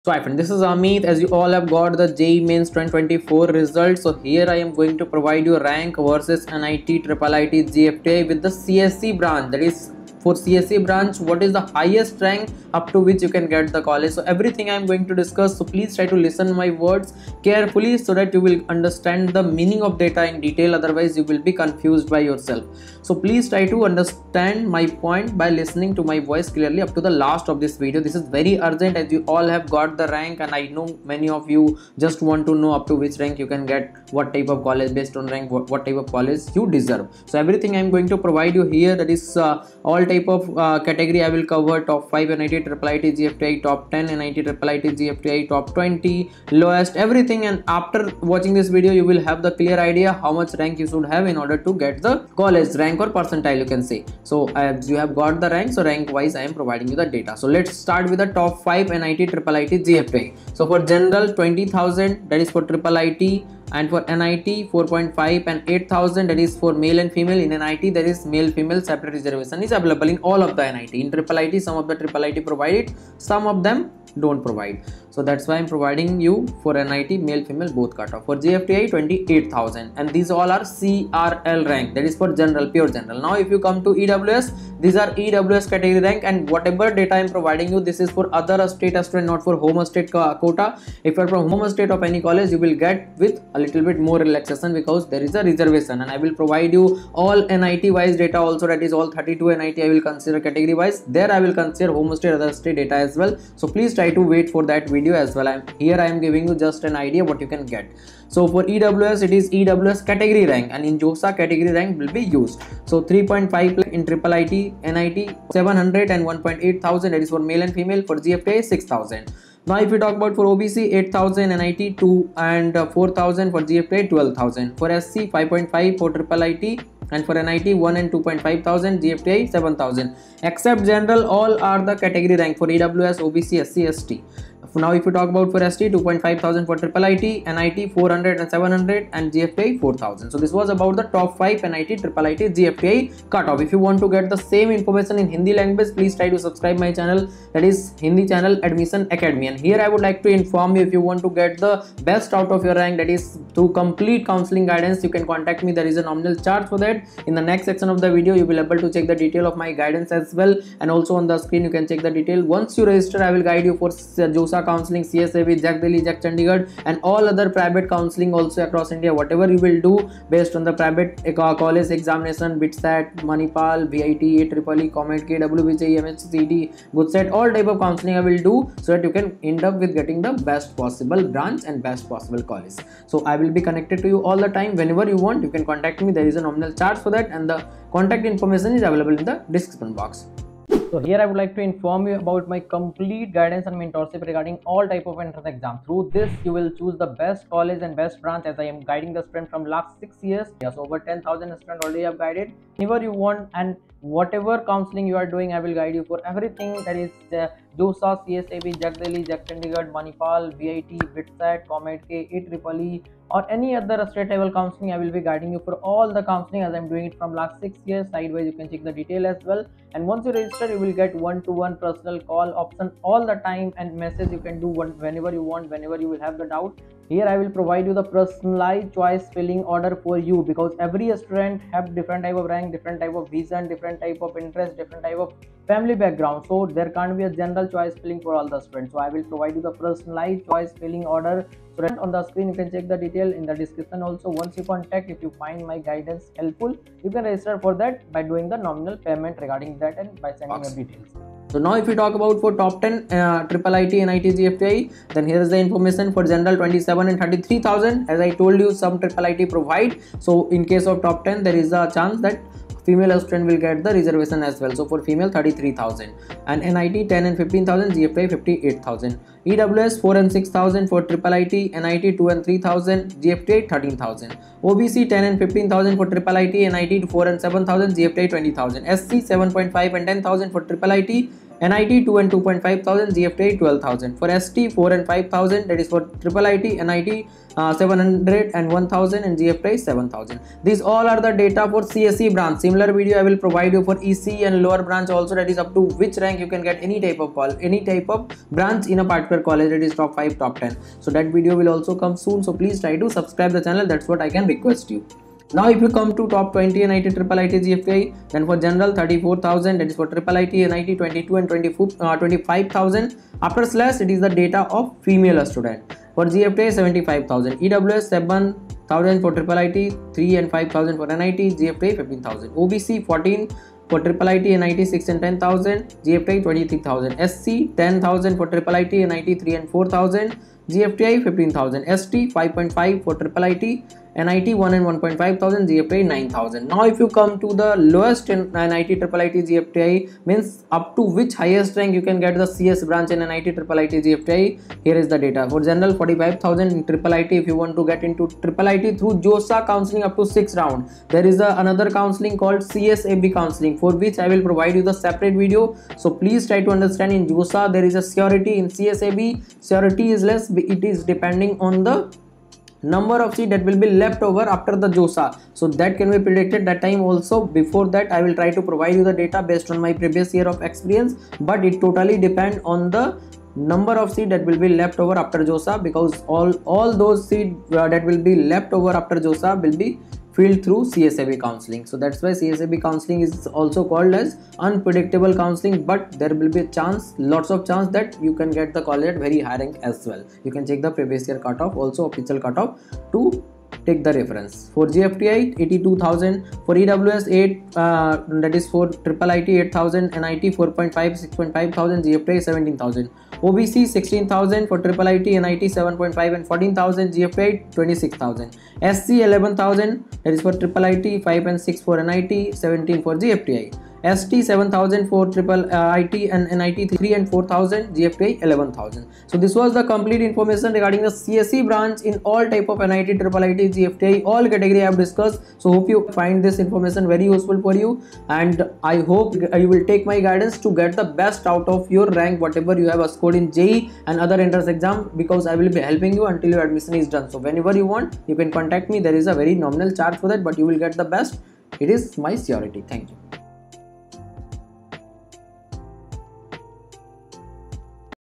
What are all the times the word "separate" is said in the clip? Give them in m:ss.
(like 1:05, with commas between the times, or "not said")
1:08, 5:54.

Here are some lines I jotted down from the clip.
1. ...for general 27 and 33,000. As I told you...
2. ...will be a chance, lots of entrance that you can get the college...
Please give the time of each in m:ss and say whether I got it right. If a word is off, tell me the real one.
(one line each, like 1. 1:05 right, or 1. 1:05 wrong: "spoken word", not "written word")
1. 4:16 right
2. 6:26 wrong: "chance", not "entrance".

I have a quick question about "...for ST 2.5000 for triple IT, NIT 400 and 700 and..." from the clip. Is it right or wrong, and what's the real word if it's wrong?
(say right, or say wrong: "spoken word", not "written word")
right.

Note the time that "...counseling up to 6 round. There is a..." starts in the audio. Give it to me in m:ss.
5:49.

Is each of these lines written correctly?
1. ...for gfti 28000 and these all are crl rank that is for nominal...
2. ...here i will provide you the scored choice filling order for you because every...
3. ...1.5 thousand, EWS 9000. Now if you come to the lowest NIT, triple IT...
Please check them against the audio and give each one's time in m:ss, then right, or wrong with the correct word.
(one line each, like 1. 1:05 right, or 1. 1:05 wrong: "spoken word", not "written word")
1. 1:18 wrong: "general", not "nominal"
2. 3:47 wrong: "personalized", not "scored"
3. 5:34 wrong: "GFTI", not "EWS".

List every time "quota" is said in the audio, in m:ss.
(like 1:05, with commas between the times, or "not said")
1:30.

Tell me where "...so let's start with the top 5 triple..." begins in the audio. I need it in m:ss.
0:57.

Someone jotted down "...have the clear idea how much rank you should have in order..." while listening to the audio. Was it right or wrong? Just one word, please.
right.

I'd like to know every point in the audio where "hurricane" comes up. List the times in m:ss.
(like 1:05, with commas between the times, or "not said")
not said.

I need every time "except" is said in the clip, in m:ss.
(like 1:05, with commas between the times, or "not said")
2:10.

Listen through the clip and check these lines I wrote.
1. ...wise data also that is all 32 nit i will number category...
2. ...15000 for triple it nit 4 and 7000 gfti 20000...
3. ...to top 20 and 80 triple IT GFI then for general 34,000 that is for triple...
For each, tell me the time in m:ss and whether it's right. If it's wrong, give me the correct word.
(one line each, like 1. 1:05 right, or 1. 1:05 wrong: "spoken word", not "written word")
1. 1:37 wrong: "consider", not "number"
2. 4:35 right
3. 5:06 right.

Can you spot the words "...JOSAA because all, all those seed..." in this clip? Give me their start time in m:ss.
6:15.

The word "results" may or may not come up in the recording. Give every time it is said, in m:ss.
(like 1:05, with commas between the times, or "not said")
0:03.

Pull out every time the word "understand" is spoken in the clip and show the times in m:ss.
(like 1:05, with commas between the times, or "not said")
0:18, 0:23, 5:56.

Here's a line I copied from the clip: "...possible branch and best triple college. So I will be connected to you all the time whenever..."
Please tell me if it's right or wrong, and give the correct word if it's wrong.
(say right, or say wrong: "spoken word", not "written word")
wrong: "possible", not "triple".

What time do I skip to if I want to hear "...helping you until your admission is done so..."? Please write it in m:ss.
7:15.